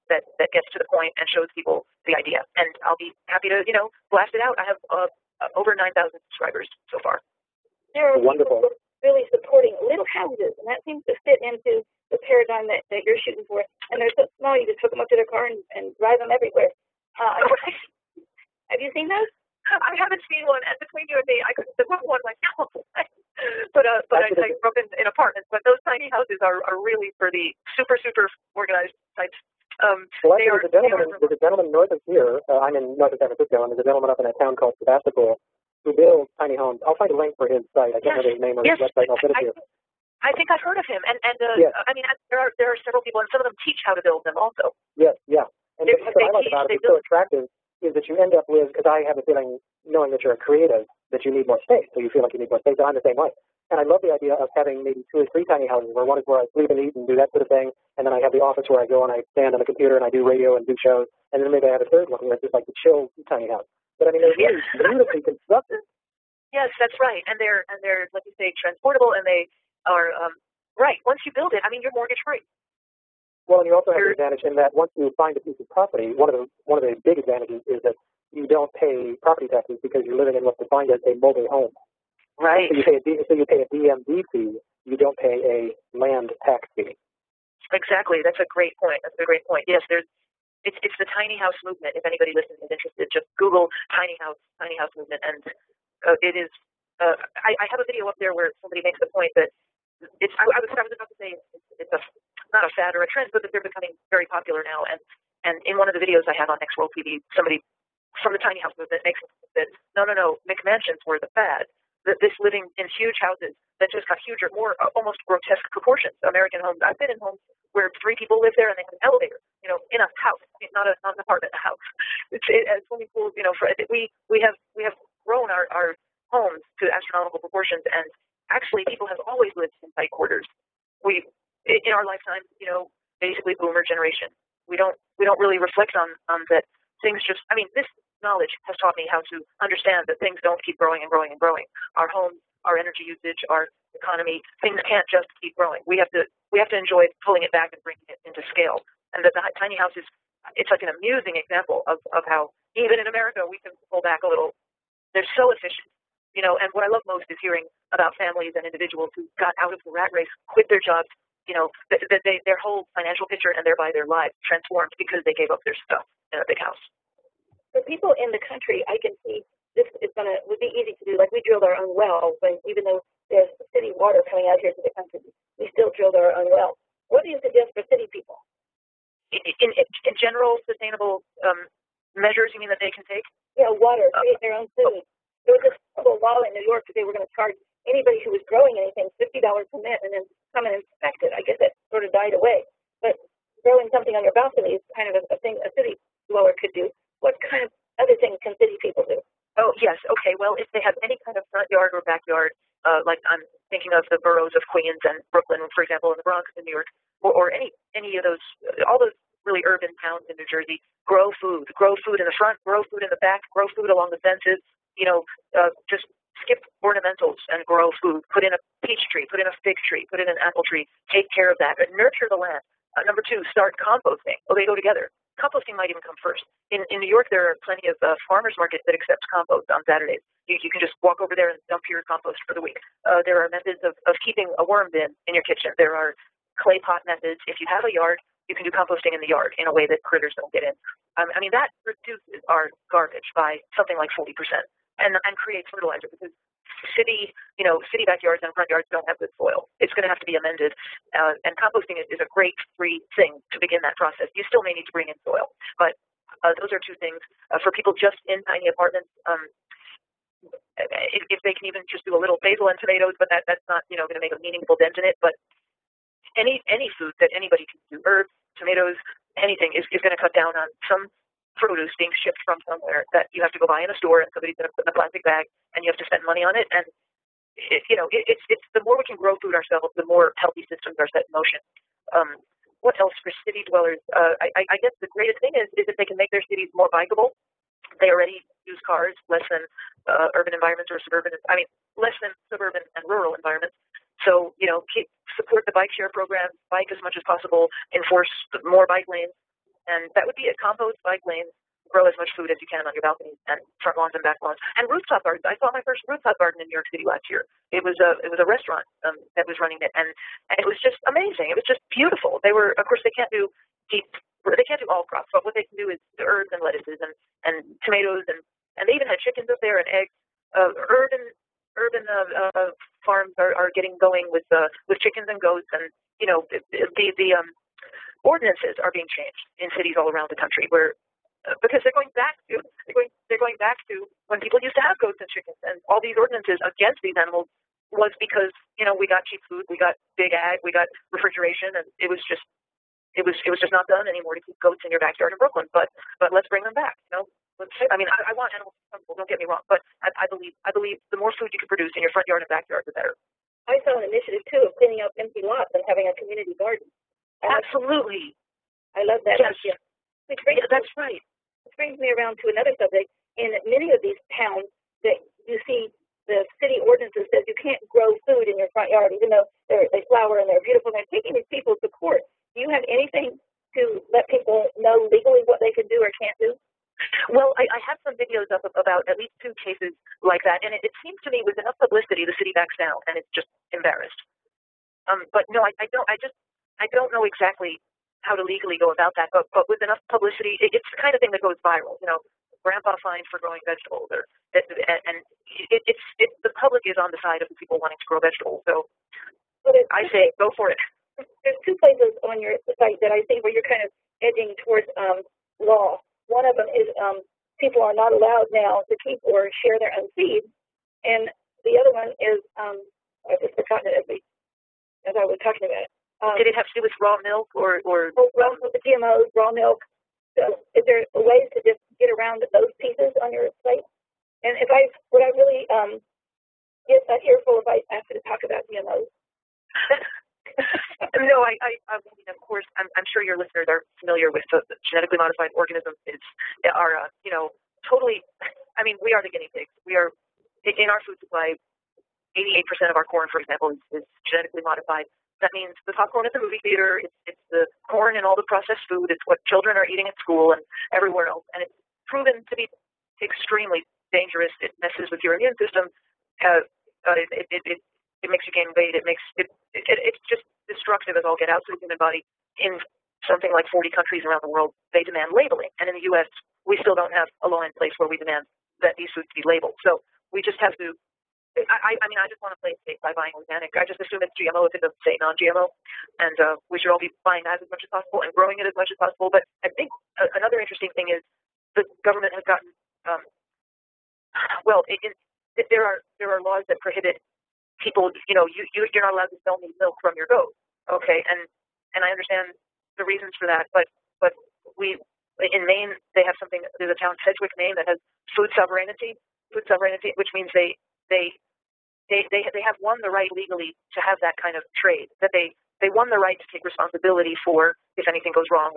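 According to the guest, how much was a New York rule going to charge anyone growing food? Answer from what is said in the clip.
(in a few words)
$50 a minute.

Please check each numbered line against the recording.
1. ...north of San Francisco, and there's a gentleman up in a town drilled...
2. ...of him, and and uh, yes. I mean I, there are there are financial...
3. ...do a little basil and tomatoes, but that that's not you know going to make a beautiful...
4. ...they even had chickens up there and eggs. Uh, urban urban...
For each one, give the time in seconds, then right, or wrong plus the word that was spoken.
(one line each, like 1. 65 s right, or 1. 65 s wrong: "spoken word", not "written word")
1. 32 s wrong: "called", not "drilled"
2. 40 s wrong: "several", not "financial"
3. 262 s wrong: "meaningful", not "beautiful"
4. 318 s right.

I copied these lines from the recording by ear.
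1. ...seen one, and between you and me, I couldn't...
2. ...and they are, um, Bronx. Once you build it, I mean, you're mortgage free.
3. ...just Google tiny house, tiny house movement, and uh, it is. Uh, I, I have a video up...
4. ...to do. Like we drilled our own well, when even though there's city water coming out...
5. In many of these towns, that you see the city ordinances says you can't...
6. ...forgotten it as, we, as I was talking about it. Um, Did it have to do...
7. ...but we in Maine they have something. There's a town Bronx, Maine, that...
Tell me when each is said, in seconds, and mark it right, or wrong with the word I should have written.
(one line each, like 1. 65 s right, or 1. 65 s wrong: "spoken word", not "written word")
1. 20 s right
2. 69 s wrong: "Right", not "Bronx"
3. 93 s right
4. 170 s right
5. 363 s right
6. 413 s right
7. 494 s wrong: "Sedgwick", not "Bronx".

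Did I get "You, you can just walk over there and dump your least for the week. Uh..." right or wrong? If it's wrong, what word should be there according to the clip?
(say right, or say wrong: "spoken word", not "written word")
wrong: "compost", not "least".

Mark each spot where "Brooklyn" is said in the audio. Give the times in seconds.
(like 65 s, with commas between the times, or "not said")
205 s, 345 s.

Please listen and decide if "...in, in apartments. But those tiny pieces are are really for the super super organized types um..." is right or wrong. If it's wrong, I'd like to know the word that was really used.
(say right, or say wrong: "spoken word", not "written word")
wrong: "houses", not "pieces".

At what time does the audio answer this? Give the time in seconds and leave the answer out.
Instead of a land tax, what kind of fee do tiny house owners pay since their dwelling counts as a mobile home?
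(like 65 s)
83 s.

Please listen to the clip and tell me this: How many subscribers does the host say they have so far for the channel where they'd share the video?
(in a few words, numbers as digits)
over 9,000.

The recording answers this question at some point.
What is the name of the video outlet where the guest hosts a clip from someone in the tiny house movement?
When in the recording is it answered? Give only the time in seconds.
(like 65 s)
106 s.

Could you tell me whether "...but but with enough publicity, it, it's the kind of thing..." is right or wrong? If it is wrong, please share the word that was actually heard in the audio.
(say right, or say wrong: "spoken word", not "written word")
right.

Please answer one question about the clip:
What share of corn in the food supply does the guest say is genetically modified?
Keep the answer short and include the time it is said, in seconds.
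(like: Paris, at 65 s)
88%, at 442 s.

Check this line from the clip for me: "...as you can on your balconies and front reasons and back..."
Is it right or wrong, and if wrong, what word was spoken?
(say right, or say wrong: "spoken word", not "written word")
wrong: "lawns", not "reasons".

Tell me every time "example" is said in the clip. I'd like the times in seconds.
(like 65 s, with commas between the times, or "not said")
151 s, 205 s, 443 s.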